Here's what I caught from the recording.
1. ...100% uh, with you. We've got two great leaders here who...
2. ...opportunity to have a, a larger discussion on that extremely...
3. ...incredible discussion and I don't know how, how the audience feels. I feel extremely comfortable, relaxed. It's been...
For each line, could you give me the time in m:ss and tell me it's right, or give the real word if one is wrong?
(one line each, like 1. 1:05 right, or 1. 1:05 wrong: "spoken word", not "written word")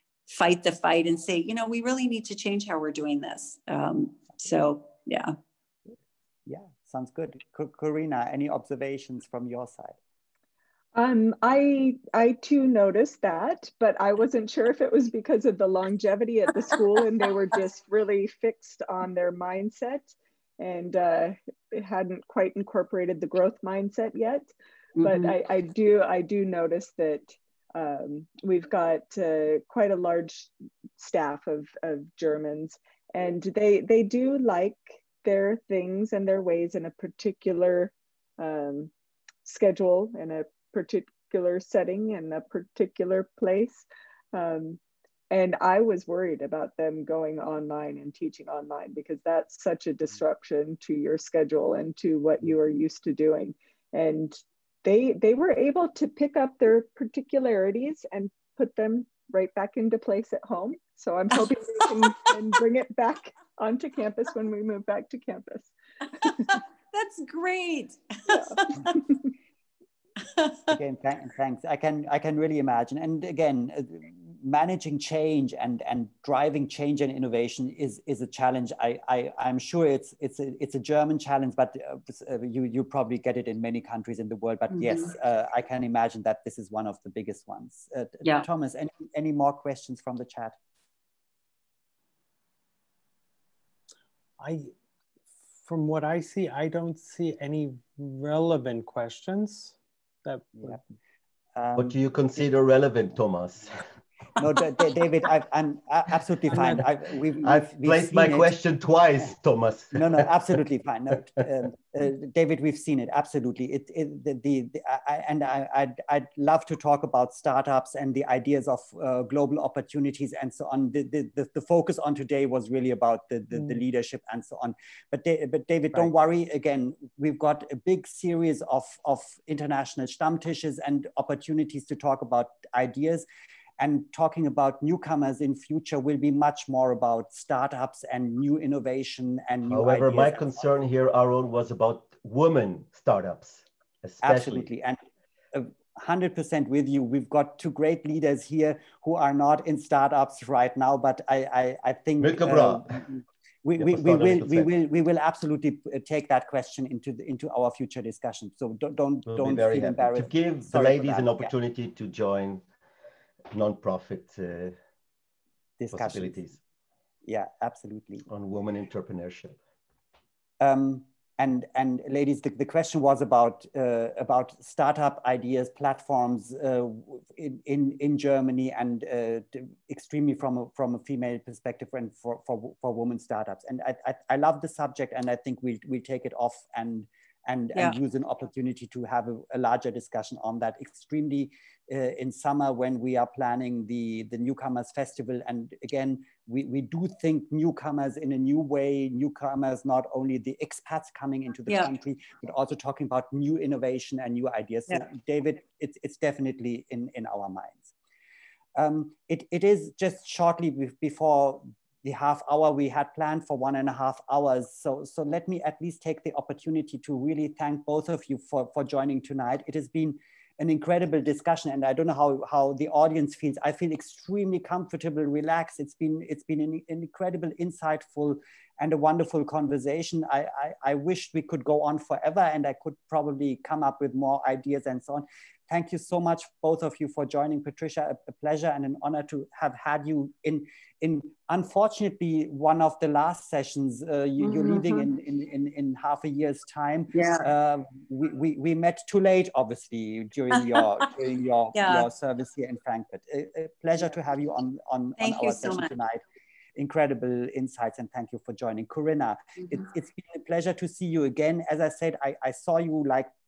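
1. 2:26 right
2. 3:08 right
3. 3:40 right.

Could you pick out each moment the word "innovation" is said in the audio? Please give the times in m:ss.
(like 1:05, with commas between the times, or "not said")
1:17, 2:18, 3:23.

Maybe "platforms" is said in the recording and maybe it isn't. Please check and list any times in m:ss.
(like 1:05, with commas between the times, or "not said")
2:55.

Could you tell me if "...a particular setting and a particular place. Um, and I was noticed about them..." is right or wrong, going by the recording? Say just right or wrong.
wrong.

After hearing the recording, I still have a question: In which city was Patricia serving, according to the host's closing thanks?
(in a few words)
Frankfurt.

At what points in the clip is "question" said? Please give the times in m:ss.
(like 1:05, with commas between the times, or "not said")
1:29, 1:38, 1:48, 2:36, 2:52.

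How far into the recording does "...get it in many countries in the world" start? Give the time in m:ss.
1:23.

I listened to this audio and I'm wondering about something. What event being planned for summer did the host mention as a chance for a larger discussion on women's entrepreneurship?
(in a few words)
Newcomers festival.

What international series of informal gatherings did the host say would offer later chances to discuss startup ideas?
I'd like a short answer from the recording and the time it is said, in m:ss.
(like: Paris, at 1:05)
Stammtisches, at 2:10.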